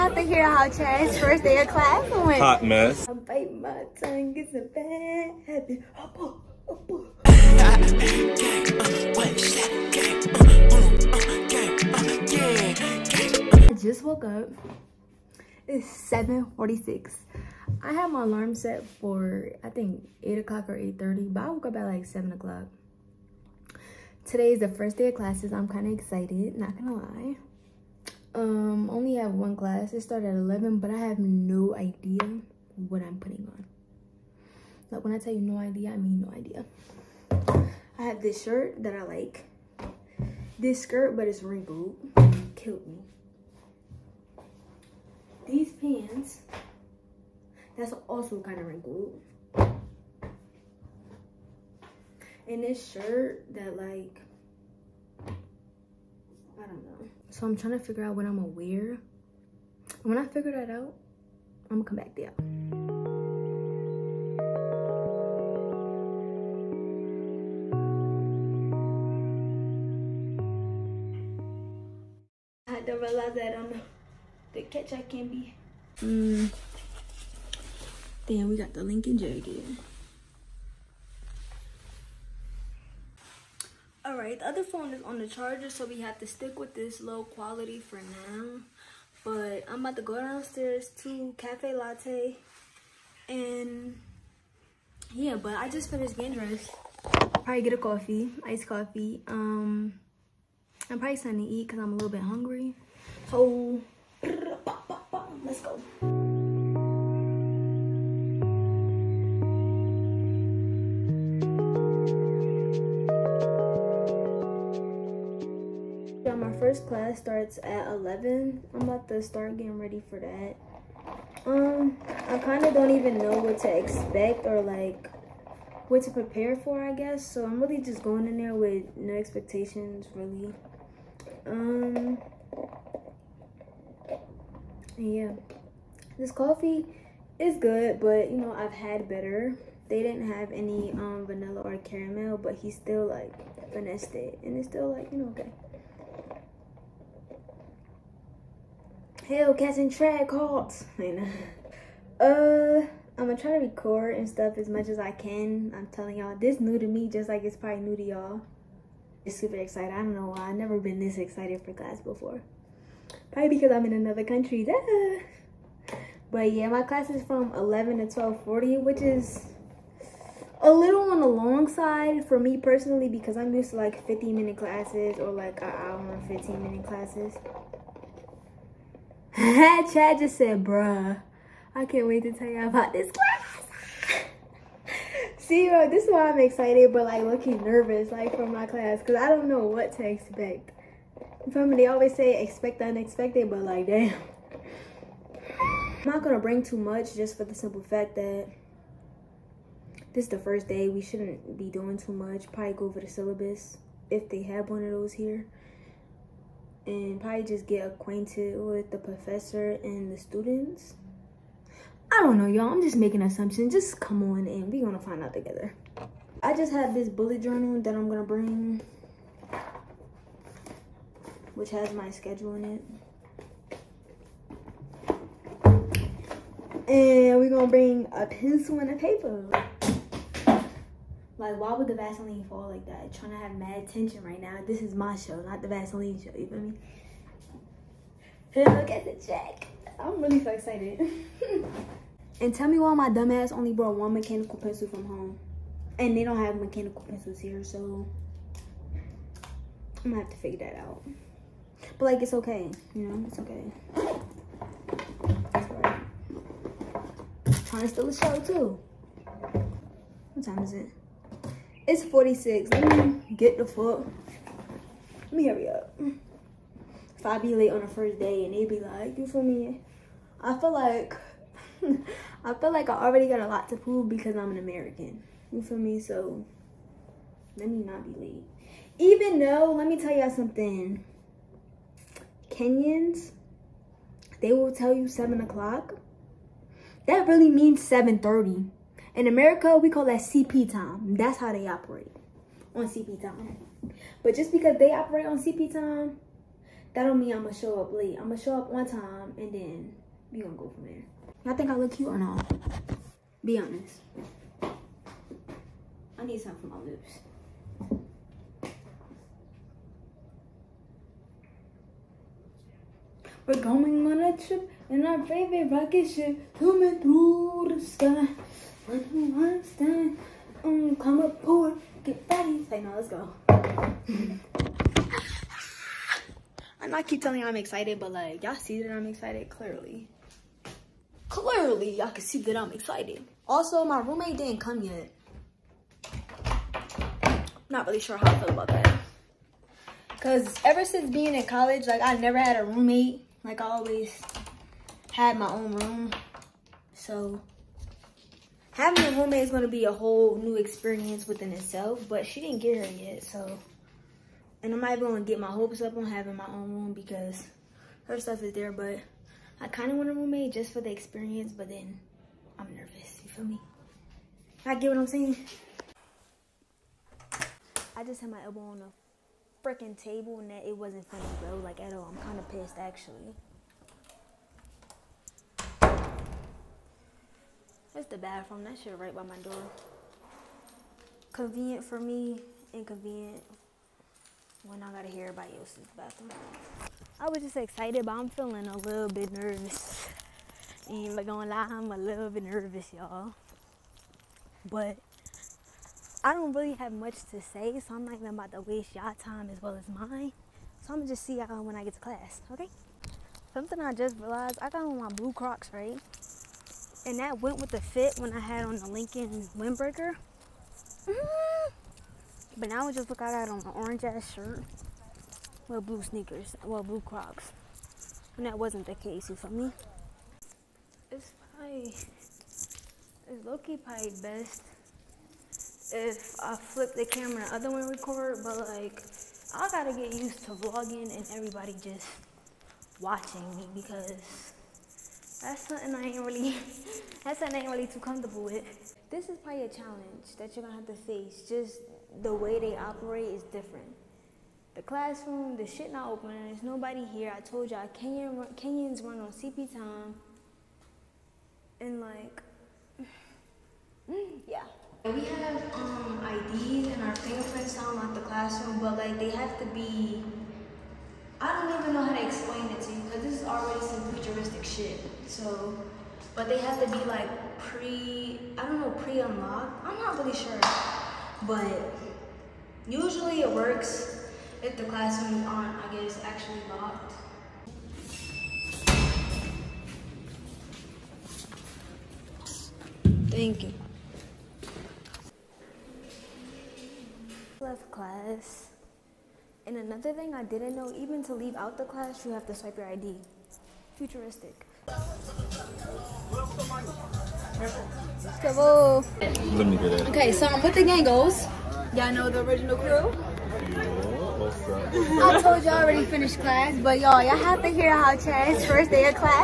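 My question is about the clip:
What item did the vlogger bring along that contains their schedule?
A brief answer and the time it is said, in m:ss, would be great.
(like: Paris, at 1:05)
bullet journal, at 3:37.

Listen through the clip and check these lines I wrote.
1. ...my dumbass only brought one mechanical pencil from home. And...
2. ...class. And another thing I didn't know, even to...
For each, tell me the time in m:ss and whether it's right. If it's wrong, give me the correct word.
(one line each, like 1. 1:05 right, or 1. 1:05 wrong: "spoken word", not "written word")
1. 4:02 right
2. 8:07 right.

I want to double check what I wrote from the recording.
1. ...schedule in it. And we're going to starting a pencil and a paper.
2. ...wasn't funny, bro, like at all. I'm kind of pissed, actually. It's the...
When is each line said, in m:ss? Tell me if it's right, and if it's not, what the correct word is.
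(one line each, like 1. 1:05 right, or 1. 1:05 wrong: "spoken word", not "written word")
1. 3:42 wrong: "bring", not "starting"
2. 6:10 right.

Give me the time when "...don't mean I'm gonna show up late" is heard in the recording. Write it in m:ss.
4:57.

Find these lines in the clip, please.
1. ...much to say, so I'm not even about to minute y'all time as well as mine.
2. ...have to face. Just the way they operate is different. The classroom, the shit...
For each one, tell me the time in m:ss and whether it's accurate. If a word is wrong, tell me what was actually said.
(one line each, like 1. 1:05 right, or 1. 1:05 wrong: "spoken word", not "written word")
1. 6:36 wrong: "waste", not "minute"
2. 7:20 right.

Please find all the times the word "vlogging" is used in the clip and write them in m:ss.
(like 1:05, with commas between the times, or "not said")
7:10.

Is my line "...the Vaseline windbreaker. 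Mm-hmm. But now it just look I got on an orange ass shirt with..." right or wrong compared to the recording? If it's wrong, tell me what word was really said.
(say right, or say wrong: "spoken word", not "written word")
wrong: "Lincoln", not "Vaseline".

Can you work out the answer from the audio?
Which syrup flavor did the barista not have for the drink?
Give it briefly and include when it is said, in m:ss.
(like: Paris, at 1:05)
vanilla, at 2:21.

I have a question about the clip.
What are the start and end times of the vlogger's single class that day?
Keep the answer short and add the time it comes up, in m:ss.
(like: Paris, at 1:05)
11 to 12:40, at 2:47.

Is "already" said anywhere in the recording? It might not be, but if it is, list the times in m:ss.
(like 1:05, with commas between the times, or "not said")
4:33, 7:43, 8:25.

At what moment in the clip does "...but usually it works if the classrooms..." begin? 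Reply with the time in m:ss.
7:51.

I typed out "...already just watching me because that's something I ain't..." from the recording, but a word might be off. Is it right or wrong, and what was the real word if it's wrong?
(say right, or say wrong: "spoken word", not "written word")
wrong: "everybody", not "already".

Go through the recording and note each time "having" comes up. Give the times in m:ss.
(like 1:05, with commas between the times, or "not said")
5:48, 5:56.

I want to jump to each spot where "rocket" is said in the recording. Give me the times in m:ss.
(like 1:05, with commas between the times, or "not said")
5:15.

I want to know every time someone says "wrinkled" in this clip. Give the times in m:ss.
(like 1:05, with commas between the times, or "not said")
0:41, 0:48.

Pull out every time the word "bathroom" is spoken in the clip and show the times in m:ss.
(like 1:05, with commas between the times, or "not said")
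6:18, 6:25.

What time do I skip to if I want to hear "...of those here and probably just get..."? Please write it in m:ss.
3:24.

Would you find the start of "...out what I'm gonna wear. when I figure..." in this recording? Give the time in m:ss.
0:58.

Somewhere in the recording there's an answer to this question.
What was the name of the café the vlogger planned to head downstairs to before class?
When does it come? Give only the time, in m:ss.
1:31.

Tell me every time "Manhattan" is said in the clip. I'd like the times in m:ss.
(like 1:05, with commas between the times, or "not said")
not said.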